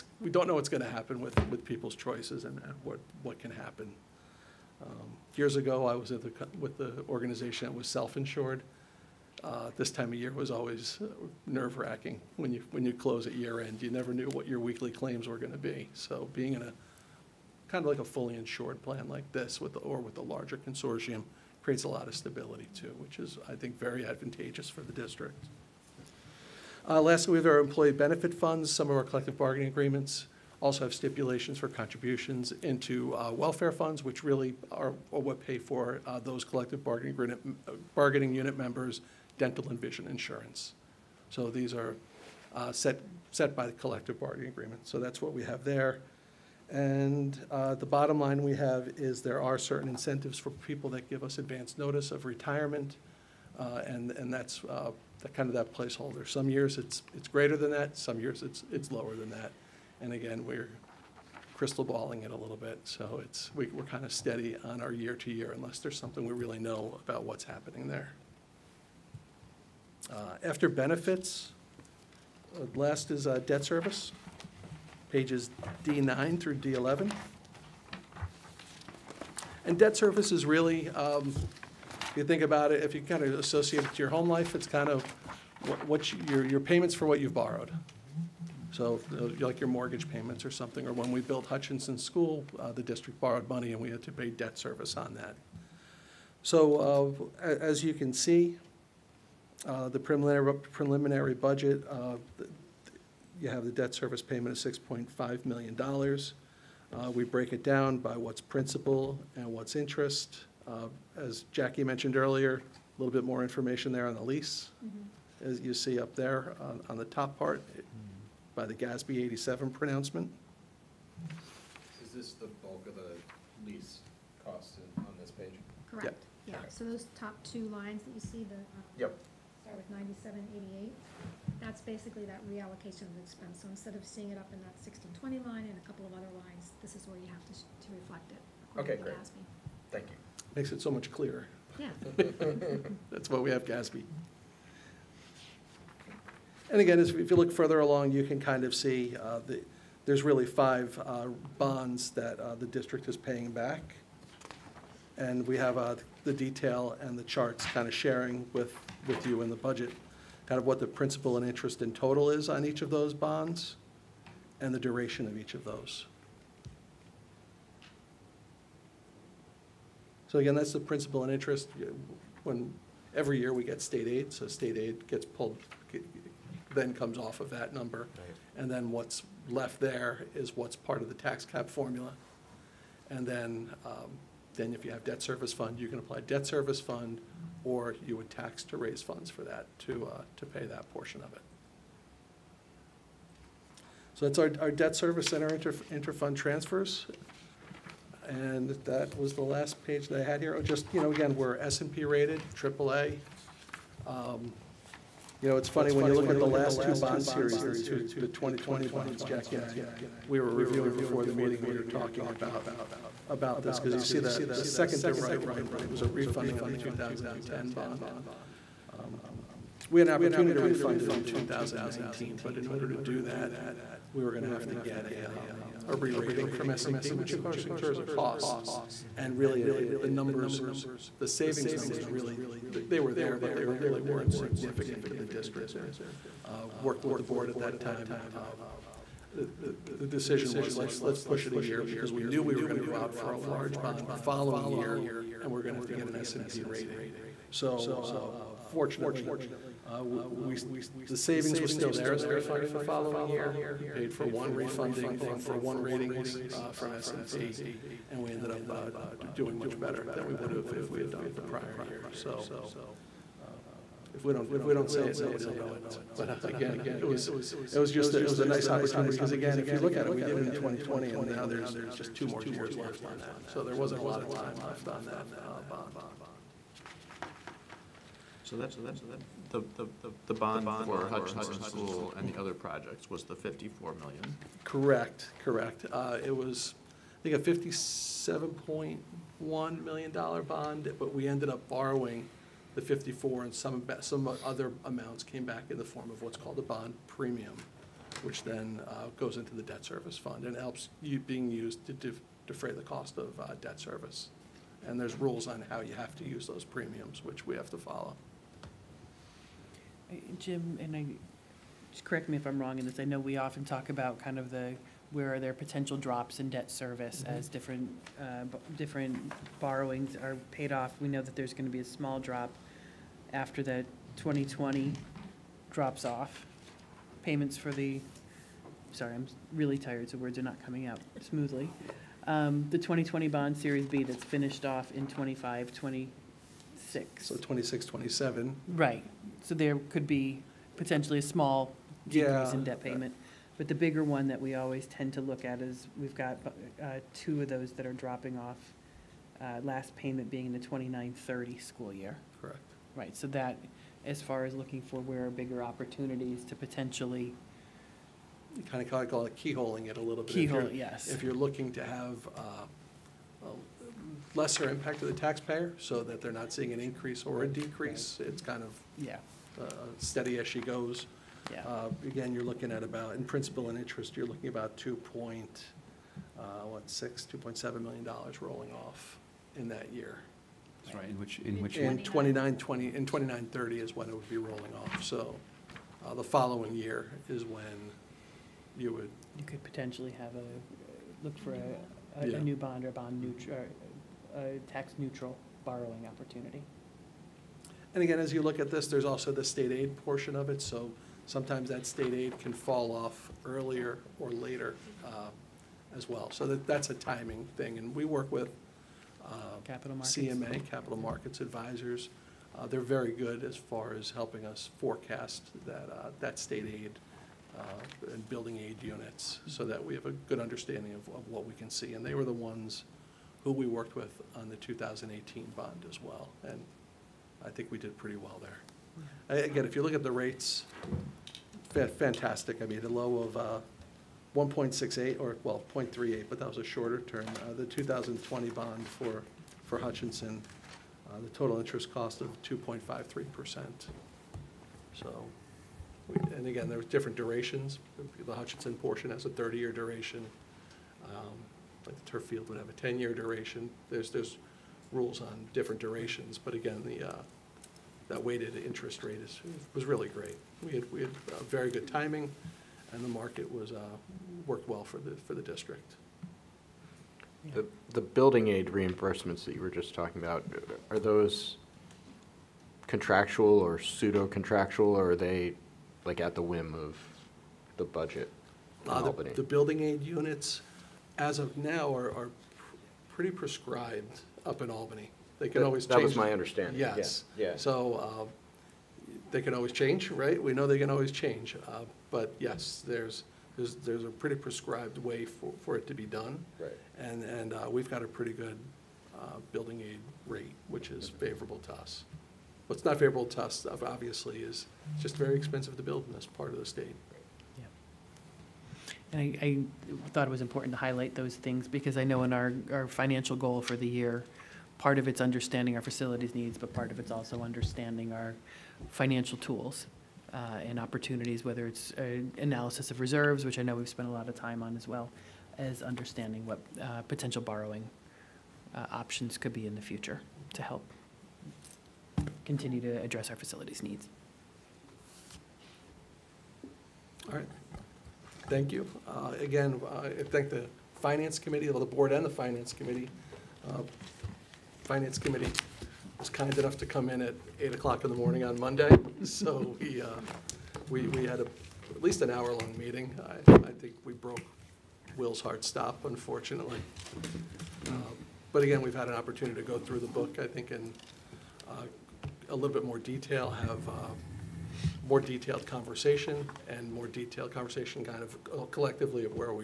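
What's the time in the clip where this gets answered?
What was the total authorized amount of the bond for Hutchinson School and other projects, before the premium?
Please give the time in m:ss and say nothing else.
4:47.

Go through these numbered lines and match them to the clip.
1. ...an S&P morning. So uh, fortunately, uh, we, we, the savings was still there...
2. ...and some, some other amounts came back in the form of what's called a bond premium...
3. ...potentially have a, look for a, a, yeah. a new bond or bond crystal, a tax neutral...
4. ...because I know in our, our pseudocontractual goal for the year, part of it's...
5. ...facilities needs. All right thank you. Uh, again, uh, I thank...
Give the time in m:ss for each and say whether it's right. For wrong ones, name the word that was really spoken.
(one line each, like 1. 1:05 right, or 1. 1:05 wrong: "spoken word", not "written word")
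1. 4:06 wrong: "rating", not "morning"
2. 4:53 right
3. 6:29 wrong: "neutral", not "crystal"
4. 8:31 wrong: "financial", not "pseudocontractual"
5. 8:53 right.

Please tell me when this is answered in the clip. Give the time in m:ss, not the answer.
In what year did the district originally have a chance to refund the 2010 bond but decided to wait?
3:41.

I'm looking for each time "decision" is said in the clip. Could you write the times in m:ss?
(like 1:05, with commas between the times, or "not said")
4:00.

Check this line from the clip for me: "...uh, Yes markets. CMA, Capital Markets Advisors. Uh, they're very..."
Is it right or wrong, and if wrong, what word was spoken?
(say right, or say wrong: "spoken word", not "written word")
wrong: "Capital", not "Yes".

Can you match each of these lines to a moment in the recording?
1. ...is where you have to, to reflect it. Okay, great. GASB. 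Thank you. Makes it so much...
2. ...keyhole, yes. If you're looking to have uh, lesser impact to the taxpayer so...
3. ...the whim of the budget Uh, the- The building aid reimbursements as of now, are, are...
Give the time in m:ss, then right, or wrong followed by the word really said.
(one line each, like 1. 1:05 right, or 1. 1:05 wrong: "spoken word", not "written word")
1. 2:16 right
2. 6:00 right
3. 7:56 wrong: "units", not "reimbursements".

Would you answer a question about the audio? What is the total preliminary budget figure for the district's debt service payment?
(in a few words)
$6.5 million.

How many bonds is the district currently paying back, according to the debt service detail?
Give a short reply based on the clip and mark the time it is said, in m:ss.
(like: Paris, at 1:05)
5, at 2:30.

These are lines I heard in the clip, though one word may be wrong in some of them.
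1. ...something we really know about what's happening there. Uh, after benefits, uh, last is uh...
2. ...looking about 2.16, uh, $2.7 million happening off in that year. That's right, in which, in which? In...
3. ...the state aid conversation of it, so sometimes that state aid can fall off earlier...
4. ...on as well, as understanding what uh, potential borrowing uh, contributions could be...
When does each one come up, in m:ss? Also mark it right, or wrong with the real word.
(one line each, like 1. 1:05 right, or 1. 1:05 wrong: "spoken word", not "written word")
1. 1:05 right
2. 6:14 wrong: "rolling", not "happening"
3. 6:39 wrong: "portion", not "conversation"
4. 8:44 wrong: "options", not "contributions".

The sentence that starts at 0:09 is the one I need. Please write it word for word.
Uh, This time of year was always nerve-wracking when you, when you close at year-end.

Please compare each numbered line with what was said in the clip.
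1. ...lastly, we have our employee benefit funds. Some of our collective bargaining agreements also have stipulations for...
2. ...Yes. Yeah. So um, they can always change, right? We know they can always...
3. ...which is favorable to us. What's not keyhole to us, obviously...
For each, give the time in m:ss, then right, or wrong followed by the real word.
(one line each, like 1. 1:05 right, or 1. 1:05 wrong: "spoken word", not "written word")
1. 0:27 right
2. 8:06 right
3. 8:20 wrong: "favorable", not "keyhole".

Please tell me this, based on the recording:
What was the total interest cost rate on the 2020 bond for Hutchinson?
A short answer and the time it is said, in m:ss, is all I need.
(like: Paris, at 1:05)
2.53%, at 7:22.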